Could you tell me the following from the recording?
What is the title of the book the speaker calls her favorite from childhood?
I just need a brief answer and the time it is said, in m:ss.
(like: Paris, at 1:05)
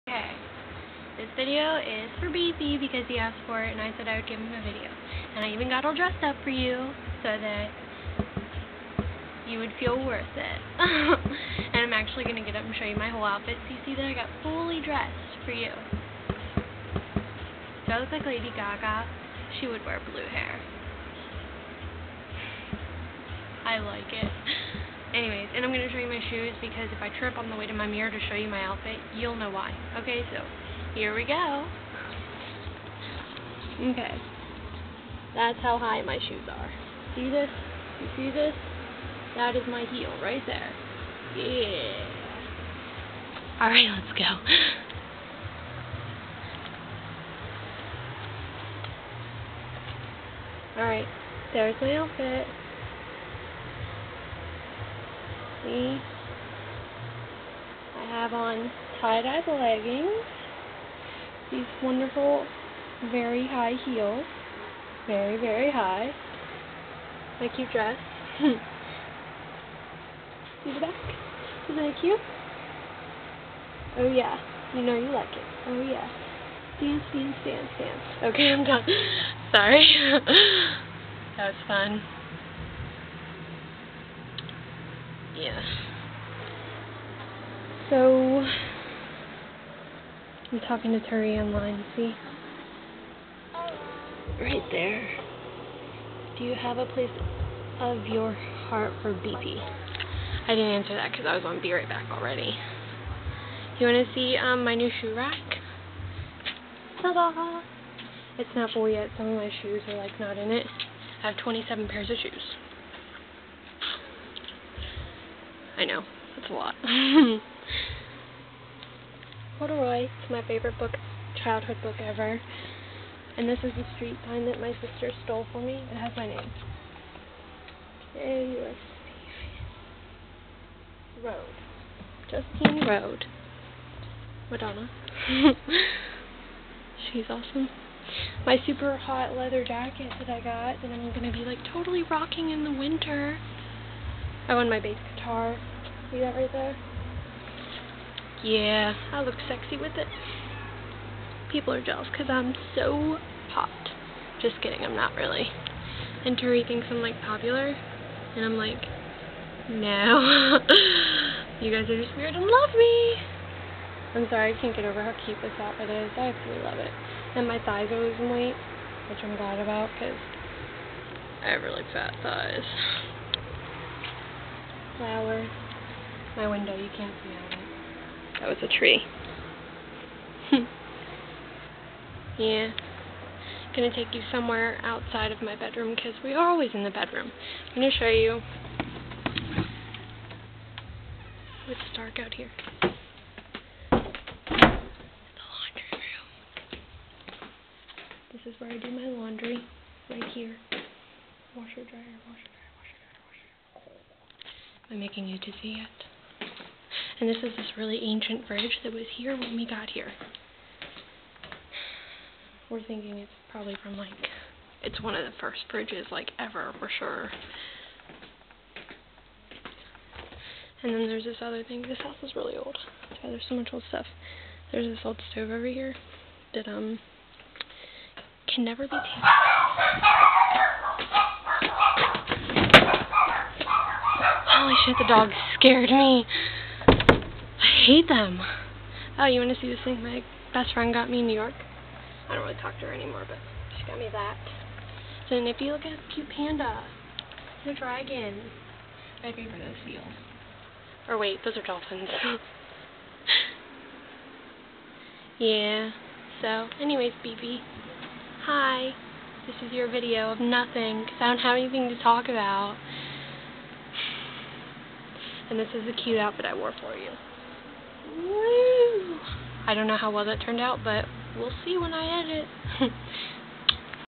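Corduroy, at 1:59.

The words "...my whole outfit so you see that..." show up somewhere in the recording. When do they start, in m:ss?
0:12.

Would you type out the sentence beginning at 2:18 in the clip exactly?
My super hot leather jacket that I got that I'm going to be like totally rocking in the winter.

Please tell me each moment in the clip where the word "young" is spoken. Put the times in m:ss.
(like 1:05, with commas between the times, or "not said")
not said.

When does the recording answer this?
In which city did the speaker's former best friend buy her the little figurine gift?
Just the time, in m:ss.
4:01.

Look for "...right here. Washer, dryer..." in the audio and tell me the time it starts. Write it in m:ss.
3:20.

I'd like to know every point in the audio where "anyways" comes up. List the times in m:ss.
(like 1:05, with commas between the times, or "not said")
0:25, 4:16.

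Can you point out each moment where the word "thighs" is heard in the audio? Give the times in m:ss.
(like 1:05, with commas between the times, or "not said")
2:47, 2:52.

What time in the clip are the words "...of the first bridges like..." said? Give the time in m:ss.
3:35.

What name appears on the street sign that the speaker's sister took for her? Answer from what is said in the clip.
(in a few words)
Justine Road.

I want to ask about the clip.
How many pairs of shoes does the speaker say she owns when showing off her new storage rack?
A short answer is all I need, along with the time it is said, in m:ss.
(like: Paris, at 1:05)
27, at 1:51.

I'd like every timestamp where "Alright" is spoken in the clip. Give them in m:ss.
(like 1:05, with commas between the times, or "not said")
0:43, 0:50.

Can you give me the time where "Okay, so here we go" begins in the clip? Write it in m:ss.
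0:30.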